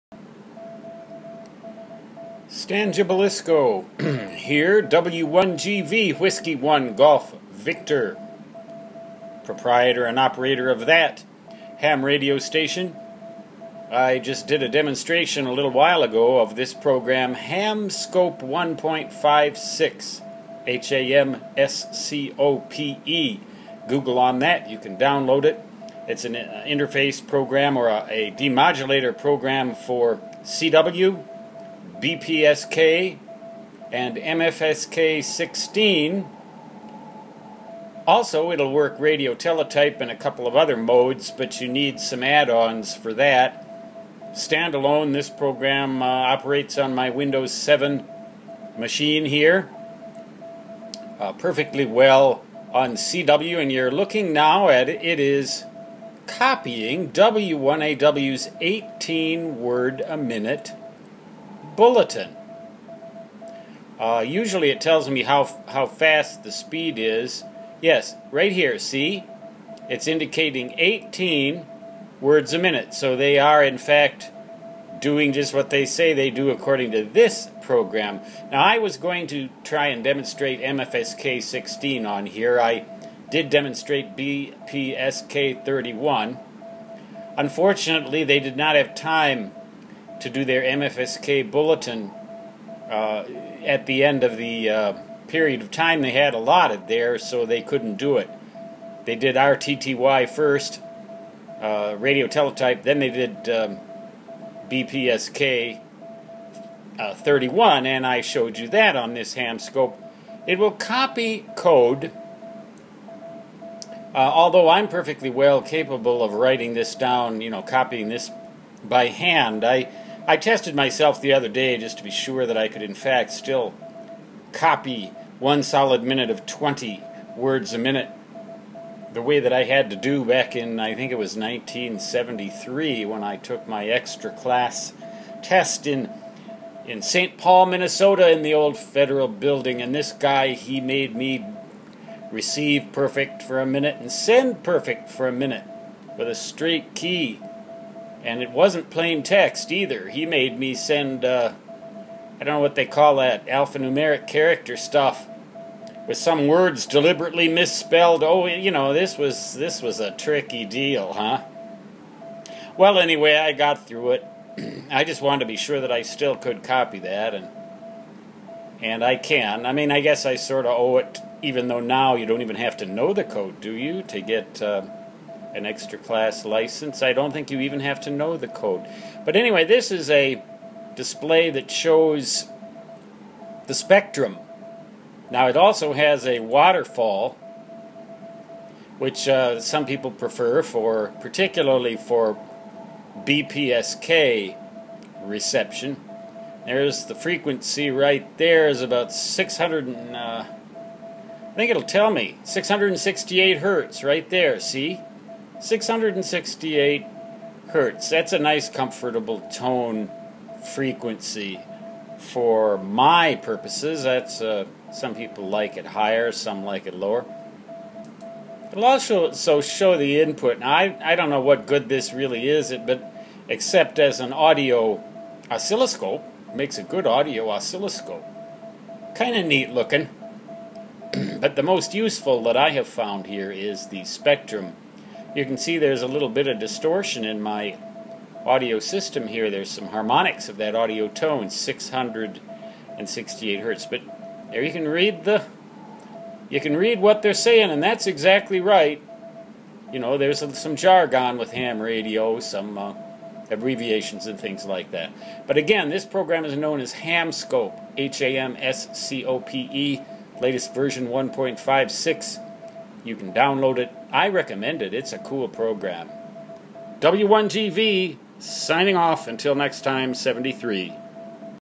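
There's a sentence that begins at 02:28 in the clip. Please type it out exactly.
And it wasn't plain text either.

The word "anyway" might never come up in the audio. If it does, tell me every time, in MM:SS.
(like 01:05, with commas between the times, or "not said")
02:42, 02:59.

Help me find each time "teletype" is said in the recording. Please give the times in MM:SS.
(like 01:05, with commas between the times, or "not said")
00:39, 01:42.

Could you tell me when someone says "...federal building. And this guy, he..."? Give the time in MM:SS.
02:18.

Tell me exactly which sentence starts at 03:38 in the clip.
It'll also so show the input.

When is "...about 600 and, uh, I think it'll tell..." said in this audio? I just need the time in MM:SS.
03:18.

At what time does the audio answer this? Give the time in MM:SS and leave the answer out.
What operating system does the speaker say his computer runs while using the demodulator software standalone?
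00:47.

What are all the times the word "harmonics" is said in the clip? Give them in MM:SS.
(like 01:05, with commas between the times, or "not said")
03:59.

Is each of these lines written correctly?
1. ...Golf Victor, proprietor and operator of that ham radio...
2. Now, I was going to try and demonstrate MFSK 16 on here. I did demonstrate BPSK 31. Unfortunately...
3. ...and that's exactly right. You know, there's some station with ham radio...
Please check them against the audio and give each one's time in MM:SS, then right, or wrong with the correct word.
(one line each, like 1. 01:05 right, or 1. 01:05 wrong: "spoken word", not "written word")
1. 00:06 right
2. 01:18 right
3. 04:07 wrong: "jargon", not "station".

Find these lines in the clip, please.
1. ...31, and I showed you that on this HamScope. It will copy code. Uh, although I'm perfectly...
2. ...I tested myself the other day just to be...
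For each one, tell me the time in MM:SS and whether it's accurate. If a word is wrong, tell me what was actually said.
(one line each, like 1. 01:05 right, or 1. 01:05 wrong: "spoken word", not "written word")
1. 01:47 right
2. 02:00 right.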